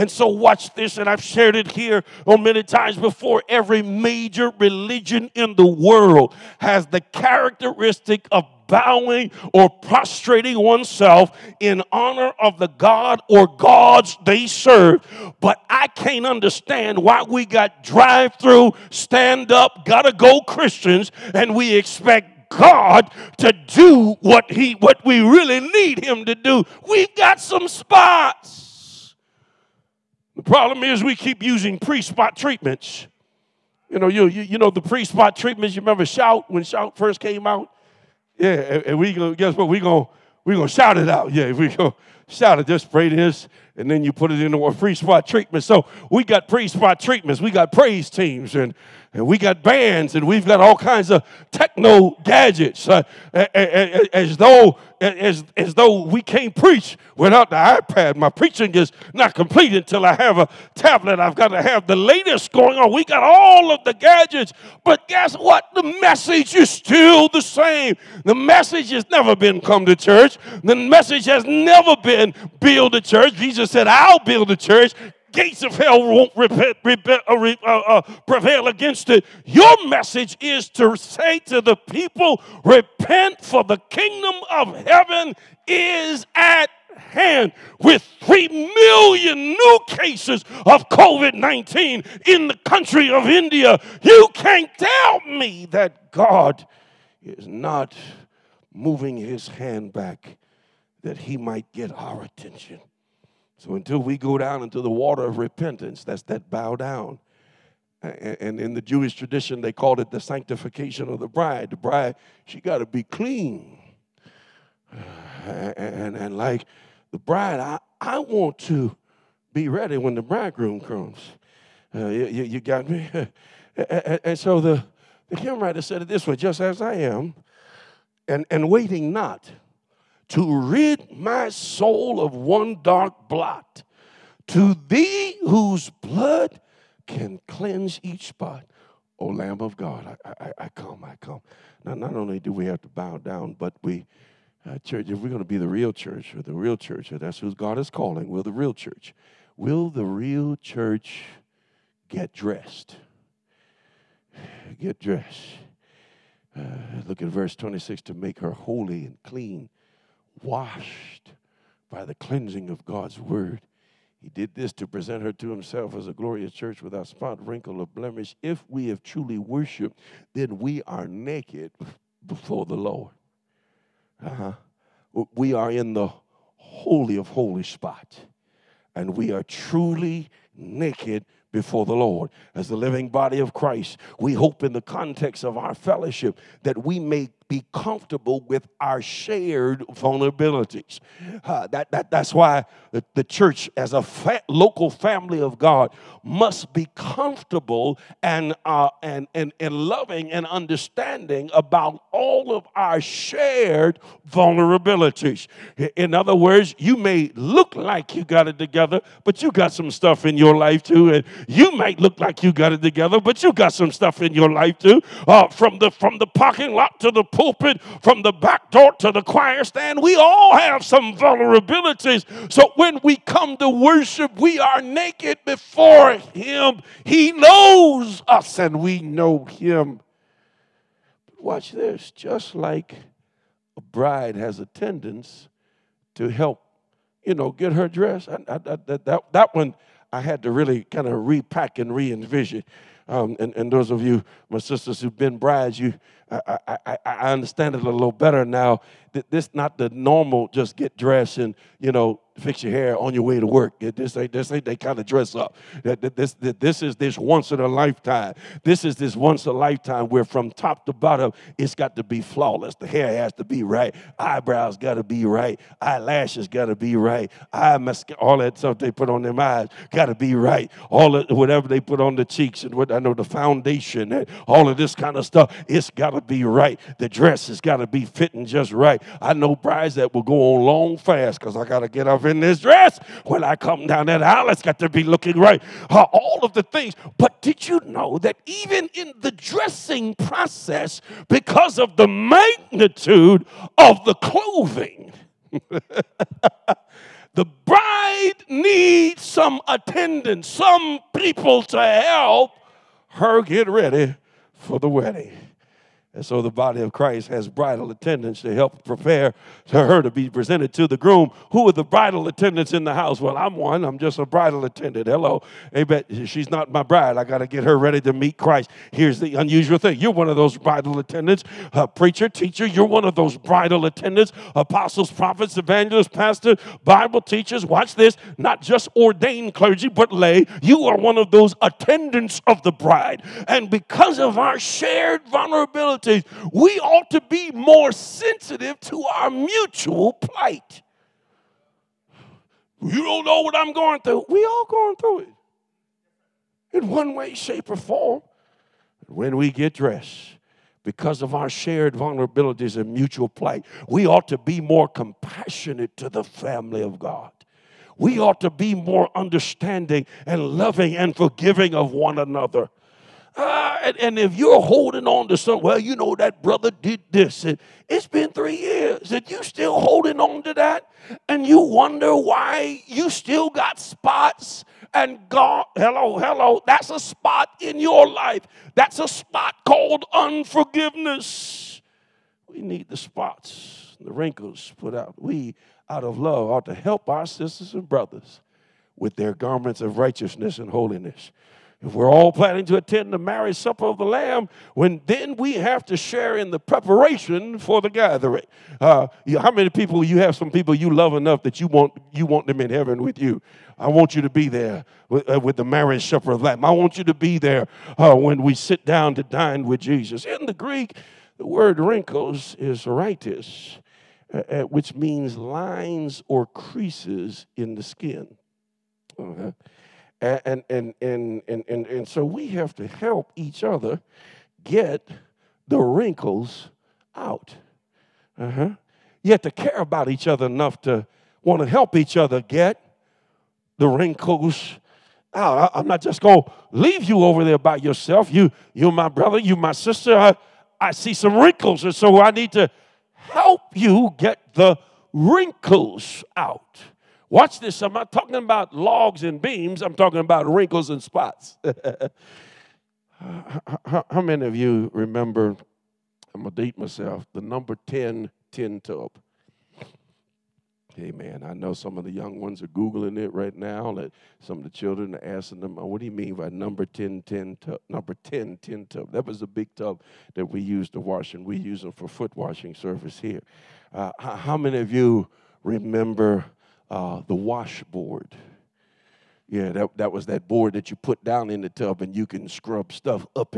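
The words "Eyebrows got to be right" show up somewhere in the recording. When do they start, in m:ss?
4:24.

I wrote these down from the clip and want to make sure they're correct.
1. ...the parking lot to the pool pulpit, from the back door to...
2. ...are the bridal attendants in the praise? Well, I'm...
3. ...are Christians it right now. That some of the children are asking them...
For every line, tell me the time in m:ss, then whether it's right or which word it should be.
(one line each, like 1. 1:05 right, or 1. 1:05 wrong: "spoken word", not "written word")
1. 3:36 right
2. 5:11 wrong: "house", not "praise"
3. 7:42 wrong: "Googling", not "Christians".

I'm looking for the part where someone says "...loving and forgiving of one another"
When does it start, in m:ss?
6:00.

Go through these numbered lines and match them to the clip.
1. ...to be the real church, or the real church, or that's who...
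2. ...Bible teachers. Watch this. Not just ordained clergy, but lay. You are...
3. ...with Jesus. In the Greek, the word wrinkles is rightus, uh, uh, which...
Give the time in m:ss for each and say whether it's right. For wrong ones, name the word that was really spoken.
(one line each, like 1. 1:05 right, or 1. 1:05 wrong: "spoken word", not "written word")
1. 2:25 right
2. 5:26 right
3. 6:49 right.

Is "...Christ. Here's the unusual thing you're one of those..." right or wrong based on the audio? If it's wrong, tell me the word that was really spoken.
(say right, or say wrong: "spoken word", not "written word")
right.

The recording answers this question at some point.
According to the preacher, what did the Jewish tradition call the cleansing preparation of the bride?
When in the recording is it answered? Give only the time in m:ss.
1:50.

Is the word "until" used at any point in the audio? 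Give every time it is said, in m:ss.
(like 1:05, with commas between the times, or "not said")
0:59, 1:43.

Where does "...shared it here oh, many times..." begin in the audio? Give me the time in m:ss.
0:01.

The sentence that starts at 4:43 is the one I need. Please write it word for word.
When I come down that aisle, it's got to be looking right.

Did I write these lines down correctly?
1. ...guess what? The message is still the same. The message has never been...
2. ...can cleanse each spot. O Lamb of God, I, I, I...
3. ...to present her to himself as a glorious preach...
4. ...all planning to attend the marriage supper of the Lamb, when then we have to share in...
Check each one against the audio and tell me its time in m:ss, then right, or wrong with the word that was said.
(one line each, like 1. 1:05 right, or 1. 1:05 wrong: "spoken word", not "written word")
1. 1:05 right
2. 2:17 right
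3. 2:44 wrong: "church", not "preach"
4. 6:32 right.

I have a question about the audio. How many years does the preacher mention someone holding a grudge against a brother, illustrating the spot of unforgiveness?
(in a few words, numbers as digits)
3.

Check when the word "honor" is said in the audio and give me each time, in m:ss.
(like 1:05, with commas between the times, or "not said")
0:11.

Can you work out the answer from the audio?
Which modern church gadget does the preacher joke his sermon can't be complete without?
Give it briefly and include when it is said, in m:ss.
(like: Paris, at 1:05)
iPad, at 0:57.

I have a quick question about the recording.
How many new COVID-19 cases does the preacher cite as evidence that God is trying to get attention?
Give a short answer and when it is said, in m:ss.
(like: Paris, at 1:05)
3 million, at 1:28.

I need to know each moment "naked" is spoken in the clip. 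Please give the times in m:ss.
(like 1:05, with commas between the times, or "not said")
2:51, 3:00, 3:44.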